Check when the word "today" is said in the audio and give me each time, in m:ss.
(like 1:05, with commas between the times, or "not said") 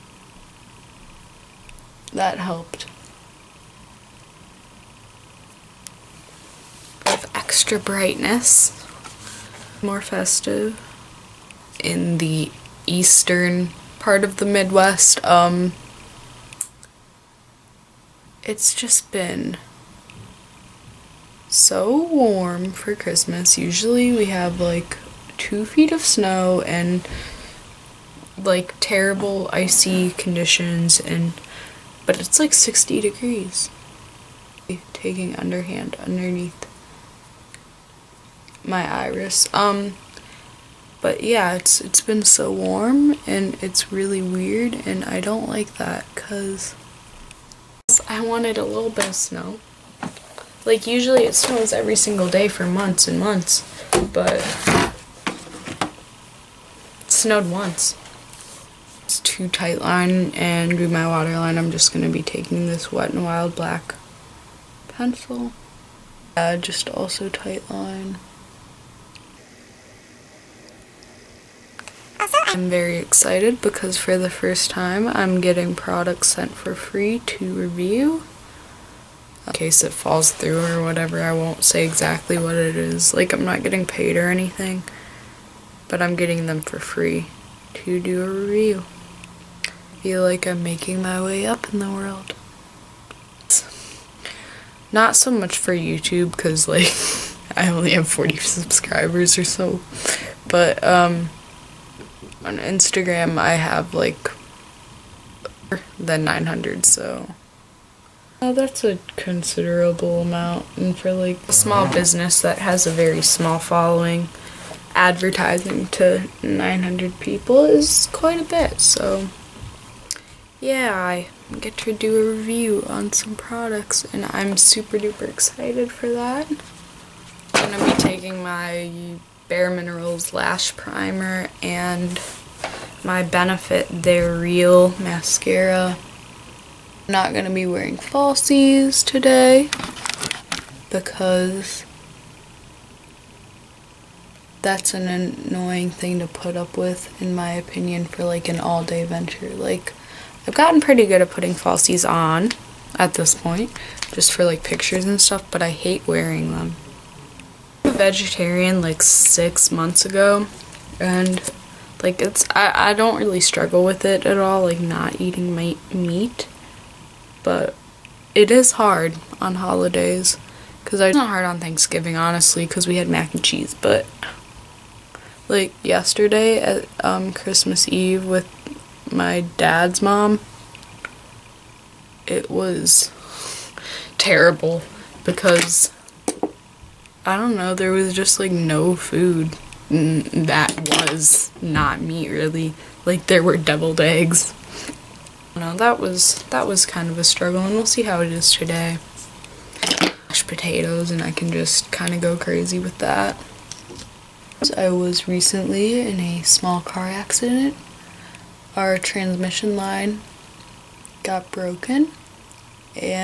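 2:19, 3:18.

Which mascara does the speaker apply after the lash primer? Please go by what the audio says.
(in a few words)
Benefit They're Real.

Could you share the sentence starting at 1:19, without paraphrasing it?
In case it falls through or whatever, I won't say exactly what it is.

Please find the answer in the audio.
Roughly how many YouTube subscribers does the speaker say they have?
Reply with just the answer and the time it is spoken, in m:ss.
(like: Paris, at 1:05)
40, at 1:38.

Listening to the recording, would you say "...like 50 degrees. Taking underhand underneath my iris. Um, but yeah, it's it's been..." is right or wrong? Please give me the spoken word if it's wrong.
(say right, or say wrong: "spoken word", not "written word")
wrong: "60", not "50".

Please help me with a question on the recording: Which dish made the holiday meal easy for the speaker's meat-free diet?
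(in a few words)
mac and cheese.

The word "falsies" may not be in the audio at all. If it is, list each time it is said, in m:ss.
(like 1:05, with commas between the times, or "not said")
2:17, 2:31.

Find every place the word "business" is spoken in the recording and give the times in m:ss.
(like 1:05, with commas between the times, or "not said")
1:51.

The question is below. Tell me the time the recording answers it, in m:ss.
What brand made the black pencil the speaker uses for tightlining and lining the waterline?
1:02.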